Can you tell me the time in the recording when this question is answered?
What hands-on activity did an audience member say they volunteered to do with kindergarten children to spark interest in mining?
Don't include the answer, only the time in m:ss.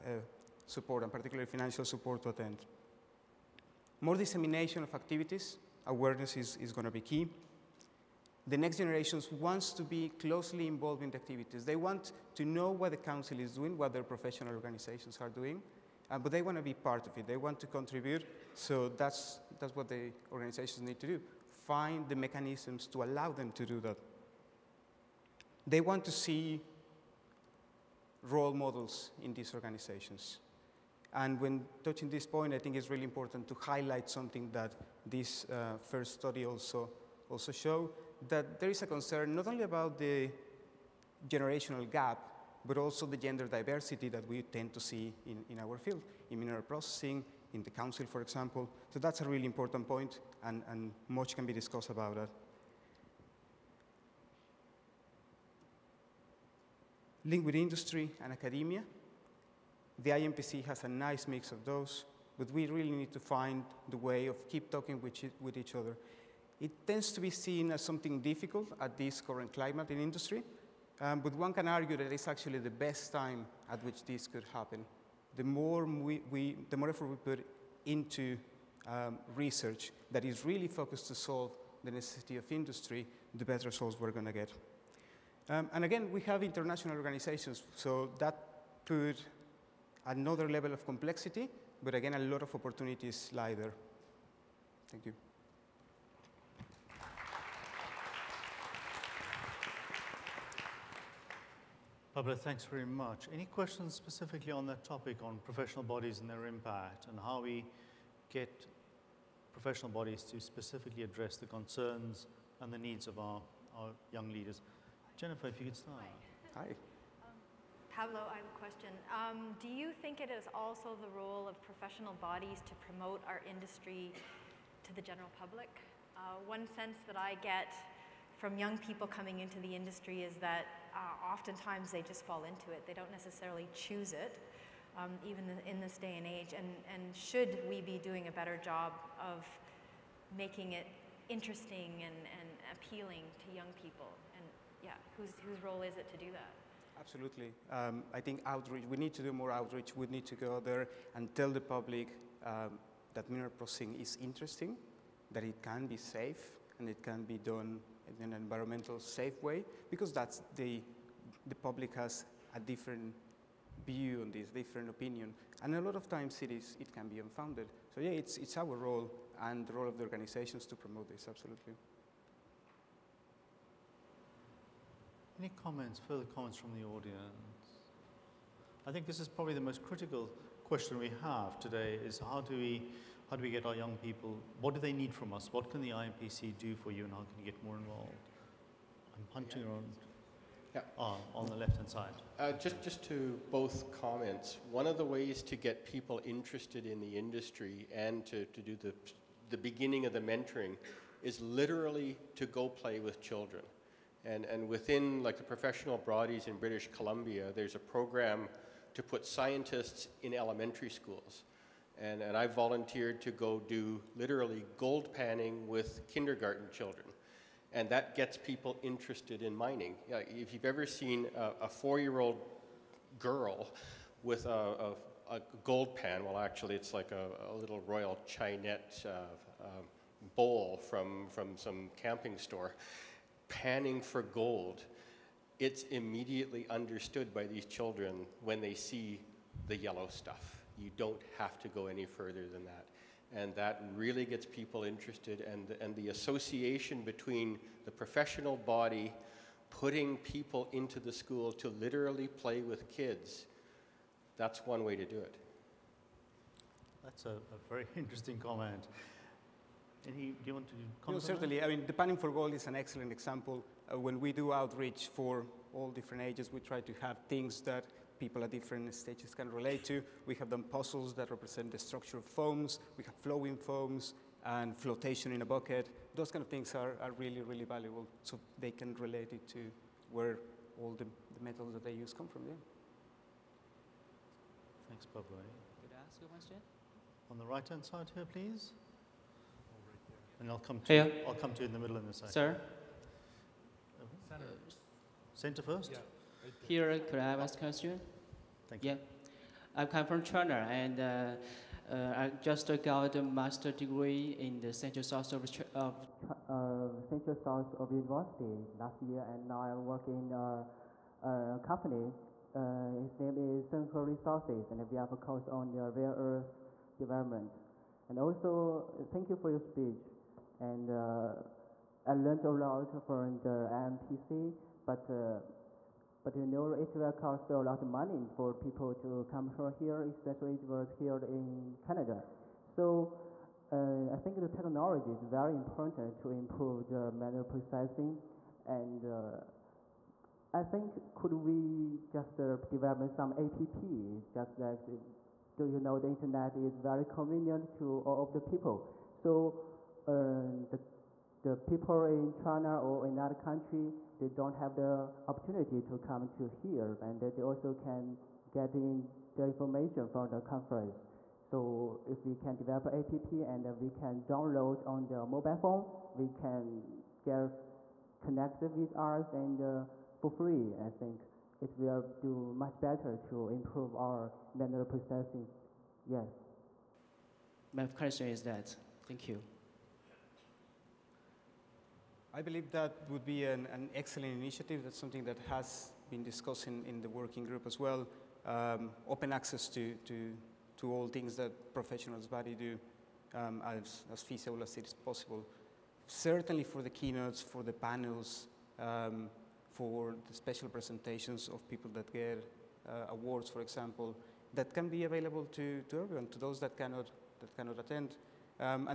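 3:34.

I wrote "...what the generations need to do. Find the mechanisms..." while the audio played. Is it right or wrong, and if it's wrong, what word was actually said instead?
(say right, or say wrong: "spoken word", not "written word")
wrong: "organizations", not "generations".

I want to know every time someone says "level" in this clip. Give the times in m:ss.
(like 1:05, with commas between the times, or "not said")
1:30.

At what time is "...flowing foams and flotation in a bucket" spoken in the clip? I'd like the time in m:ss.
4:33.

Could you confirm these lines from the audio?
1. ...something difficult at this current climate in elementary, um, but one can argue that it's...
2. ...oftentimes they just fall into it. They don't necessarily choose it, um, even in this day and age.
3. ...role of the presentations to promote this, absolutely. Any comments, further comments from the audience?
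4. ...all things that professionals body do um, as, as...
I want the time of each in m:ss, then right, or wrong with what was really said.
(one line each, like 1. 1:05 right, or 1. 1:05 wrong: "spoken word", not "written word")
1. 1:07 wrong: "industry", not "elementary"
2. 2:11 right
3. 2:49 wrong: "organizations", not "presentations"
4. 6:30 right.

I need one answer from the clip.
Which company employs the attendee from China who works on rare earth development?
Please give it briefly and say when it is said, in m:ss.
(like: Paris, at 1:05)
Senho Resources, at 5:13.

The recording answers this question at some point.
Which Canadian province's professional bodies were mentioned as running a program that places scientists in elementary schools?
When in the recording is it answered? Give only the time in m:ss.
3:26.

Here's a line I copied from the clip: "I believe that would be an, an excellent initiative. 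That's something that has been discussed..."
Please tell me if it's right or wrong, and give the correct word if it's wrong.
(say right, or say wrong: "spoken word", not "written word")
right.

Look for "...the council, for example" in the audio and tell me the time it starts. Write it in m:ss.
0:47.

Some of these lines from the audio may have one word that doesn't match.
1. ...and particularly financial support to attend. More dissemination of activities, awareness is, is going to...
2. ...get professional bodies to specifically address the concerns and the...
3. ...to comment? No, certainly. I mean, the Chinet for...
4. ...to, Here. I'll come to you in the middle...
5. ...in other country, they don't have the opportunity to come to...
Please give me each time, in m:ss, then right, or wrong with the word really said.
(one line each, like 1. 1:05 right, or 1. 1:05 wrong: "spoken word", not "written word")
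1. 0:01 right
2. 1:48 right
3. 4:20 wrong: "Panning", not "Chinet"
4. 4:50 right
5. 5:53 right.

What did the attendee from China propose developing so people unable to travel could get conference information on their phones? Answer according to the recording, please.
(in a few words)
An app.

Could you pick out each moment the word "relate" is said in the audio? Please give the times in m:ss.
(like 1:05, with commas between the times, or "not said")
4:29, 4:38.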